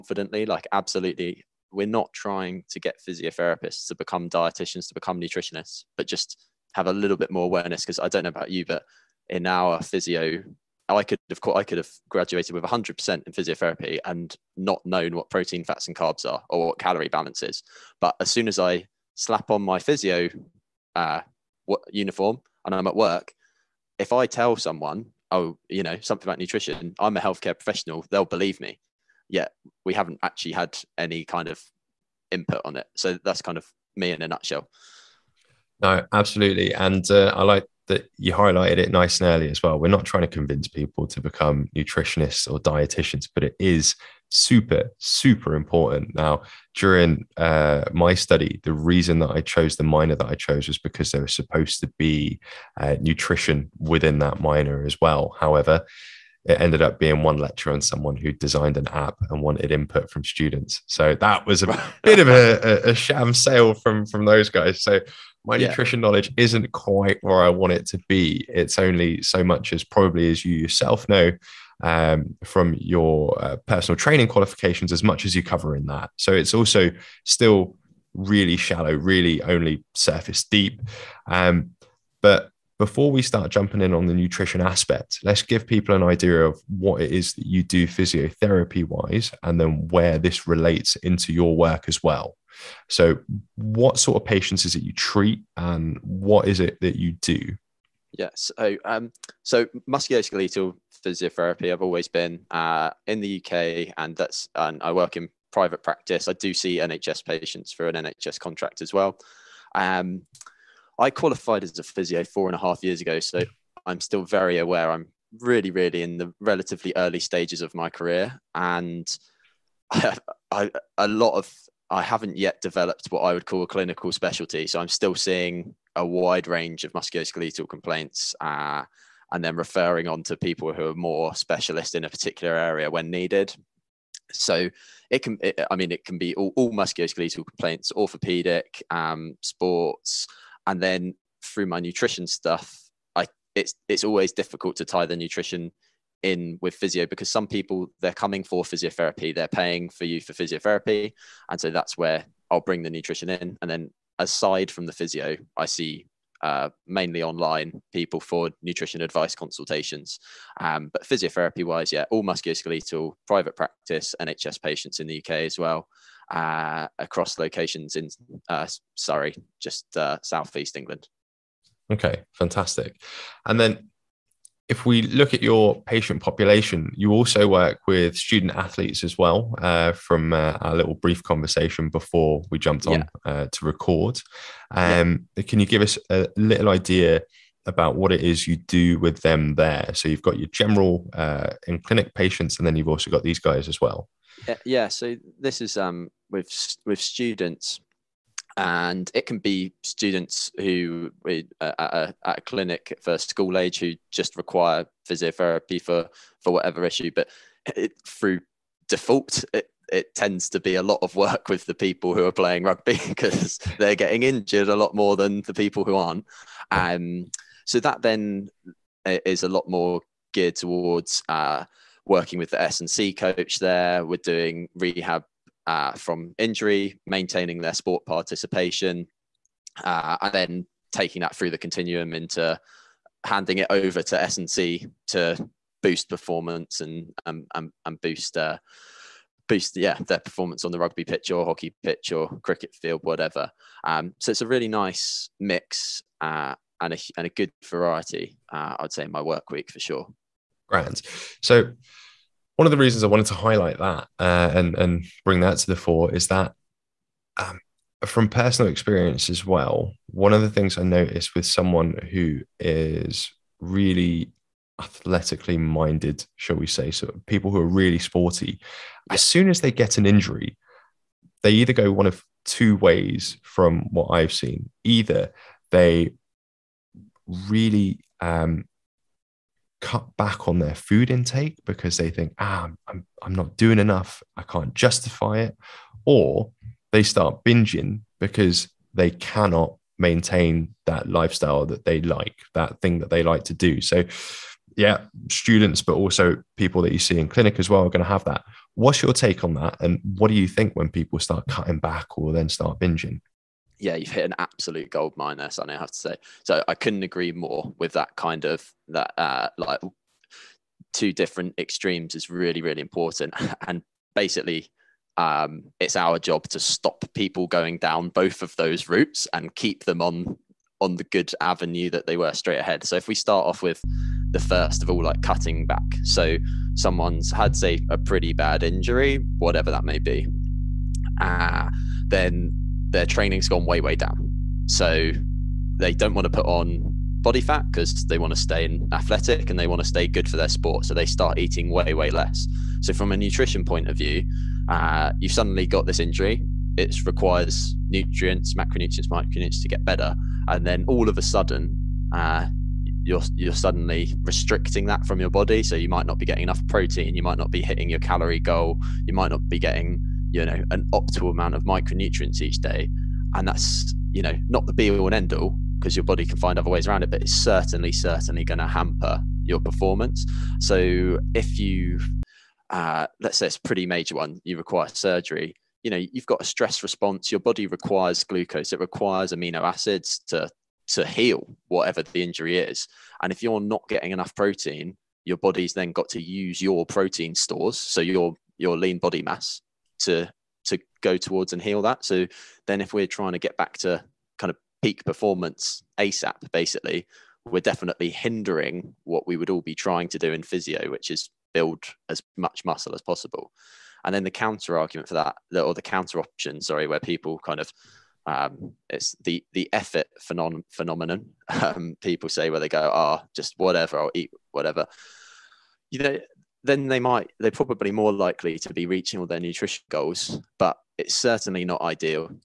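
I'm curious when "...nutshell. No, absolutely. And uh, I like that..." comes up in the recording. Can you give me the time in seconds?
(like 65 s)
34 s.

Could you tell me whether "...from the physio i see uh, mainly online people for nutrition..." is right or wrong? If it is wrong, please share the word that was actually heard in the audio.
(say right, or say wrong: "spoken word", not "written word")
right.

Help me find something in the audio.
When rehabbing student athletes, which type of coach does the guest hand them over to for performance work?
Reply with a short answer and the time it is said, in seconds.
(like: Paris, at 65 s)
S and C coach, at 222 s.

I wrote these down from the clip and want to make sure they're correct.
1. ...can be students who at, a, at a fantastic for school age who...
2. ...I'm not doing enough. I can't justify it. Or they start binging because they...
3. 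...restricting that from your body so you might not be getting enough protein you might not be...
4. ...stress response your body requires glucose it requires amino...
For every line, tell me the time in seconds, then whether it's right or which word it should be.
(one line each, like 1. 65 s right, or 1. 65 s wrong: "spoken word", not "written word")
1. 199 s wrong: "clinic", not "fantastic"
2. 283 s right
3. 354 s right
4. 376 s right.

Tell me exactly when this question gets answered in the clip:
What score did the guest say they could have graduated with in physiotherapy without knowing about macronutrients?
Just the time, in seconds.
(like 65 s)
12 s.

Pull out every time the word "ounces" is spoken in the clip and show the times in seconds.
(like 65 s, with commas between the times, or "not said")
not said.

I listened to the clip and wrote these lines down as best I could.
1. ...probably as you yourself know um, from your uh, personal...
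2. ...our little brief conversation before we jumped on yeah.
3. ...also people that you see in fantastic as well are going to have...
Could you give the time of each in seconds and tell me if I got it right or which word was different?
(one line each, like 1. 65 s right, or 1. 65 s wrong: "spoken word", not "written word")
1. 69 s right
2. 180 s right
3. 295 s wrong: "clinic", not "fantastic".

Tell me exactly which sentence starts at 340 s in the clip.
So they start eating way, way less.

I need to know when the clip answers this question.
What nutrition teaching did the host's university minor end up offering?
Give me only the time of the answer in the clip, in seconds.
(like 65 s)
57 s.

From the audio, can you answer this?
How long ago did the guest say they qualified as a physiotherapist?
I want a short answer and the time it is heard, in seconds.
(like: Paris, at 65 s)
4 and a half years, at 112 s.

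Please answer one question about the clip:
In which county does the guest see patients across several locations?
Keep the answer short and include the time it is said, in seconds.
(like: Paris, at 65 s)
Surrey, at 168 s.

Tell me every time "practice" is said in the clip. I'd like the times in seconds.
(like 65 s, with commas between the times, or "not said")
105 s, 163 s.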